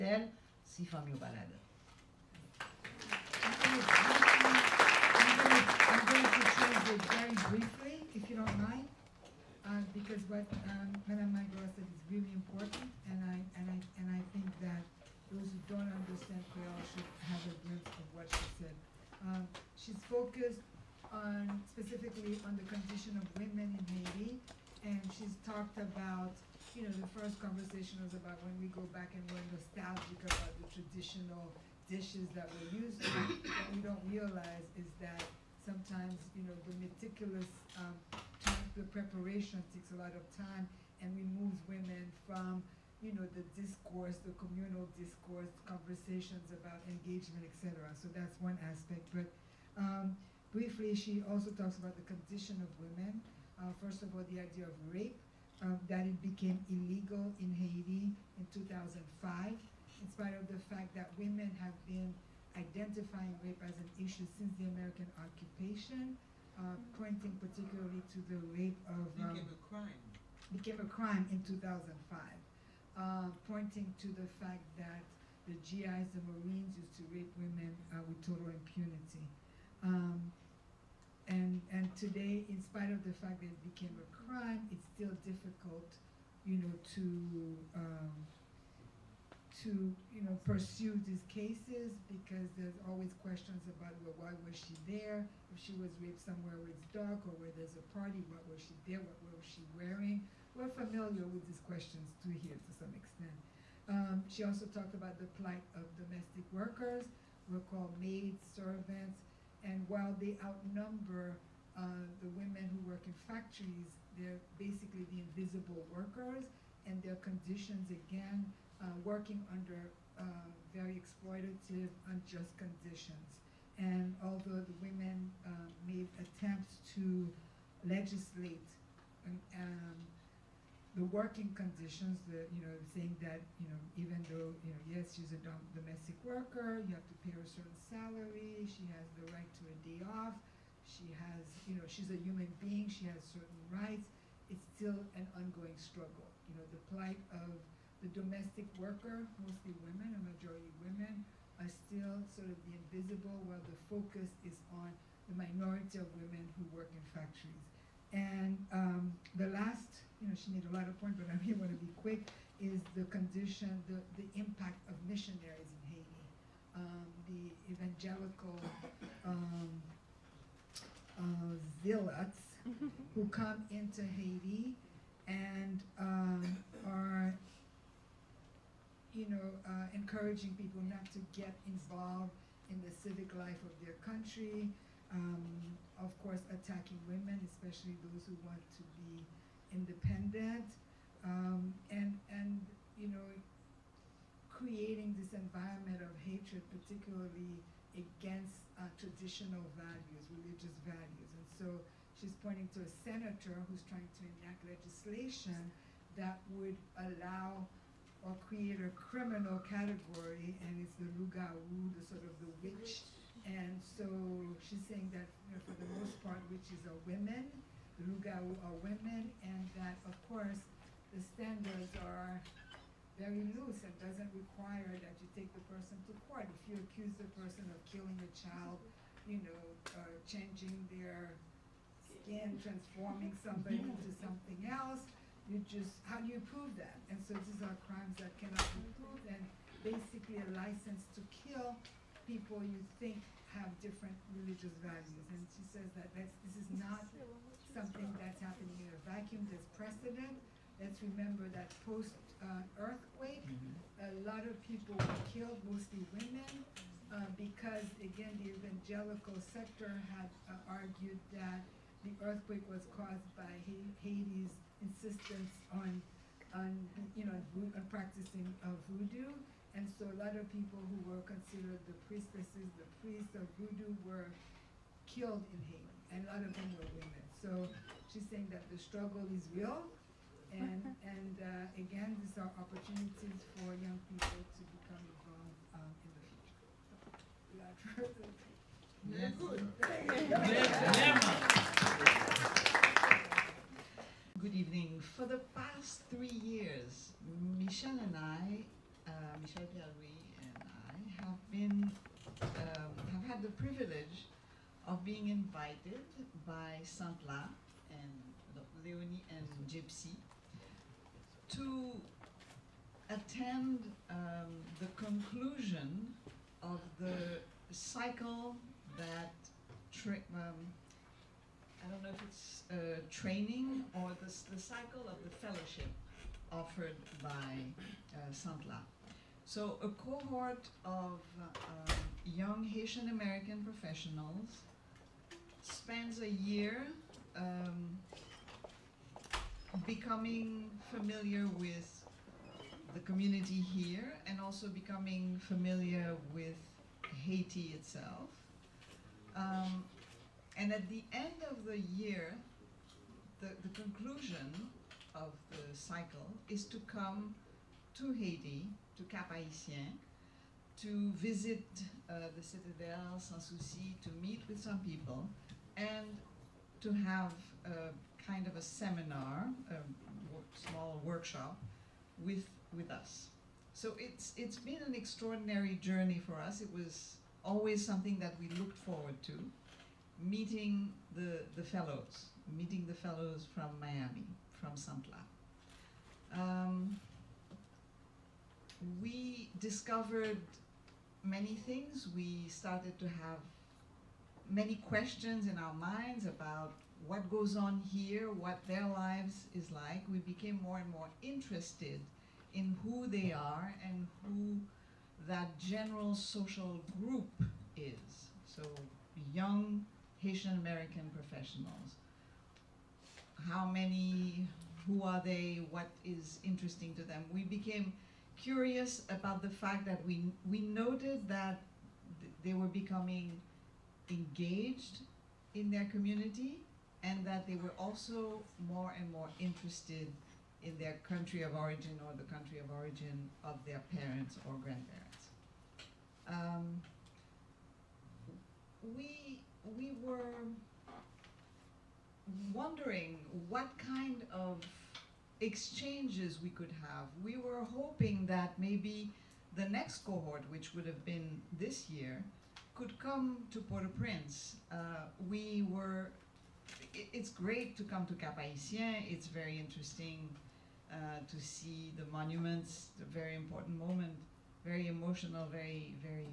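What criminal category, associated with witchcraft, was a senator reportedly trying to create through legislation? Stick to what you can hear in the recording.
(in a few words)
lugawu.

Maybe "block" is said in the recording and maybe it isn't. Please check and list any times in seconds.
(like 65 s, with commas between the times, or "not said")
not said.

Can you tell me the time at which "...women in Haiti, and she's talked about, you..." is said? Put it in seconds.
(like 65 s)
23 s.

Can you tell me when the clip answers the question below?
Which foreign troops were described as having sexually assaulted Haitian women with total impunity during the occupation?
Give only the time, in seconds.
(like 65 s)
76 s.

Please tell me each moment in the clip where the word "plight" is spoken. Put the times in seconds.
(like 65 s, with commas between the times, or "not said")
105 s, 146 s.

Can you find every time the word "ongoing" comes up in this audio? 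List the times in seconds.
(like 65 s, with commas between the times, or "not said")
145 s.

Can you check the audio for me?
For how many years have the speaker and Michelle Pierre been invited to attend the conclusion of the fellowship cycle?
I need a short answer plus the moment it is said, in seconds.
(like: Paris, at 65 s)
3, at 296 s.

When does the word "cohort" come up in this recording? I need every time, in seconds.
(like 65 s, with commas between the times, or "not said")
329 s, 449 s.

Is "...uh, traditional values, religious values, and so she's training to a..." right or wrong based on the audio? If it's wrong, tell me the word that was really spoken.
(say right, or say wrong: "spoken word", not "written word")
wrong: "pointing", not "training".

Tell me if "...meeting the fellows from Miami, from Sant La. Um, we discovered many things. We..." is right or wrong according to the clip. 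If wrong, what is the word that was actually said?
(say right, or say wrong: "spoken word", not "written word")
right.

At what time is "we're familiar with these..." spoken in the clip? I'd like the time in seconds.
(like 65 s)
100 s.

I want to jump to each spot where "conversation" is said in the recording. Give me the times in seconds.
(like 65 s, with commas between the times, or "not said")
27 s, 45 s.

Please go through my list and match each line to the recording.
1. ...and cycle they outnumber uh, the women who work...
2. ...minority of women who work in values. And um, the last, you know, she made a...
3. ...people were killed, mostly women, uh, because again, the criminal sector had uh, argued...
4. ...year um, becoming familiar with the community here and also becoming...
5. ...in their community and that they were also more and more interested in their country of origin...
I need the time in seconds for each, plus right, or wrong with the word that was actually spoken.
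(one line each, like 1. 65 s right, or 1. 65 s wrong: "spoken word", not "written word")
1. 109 s wrong: "while", not "cycle"
2. 155 s wrong: "factories", not "values"
3. 254 s wrong: "evangelical", not "criminal"
4. 336 s right
5. 425 s right.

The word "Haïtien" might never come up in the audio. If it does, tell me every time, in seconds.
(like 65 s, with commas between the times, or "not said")
359 s, 458 s.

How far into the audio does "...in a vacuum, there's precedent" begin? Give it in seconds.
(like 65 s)
248 s.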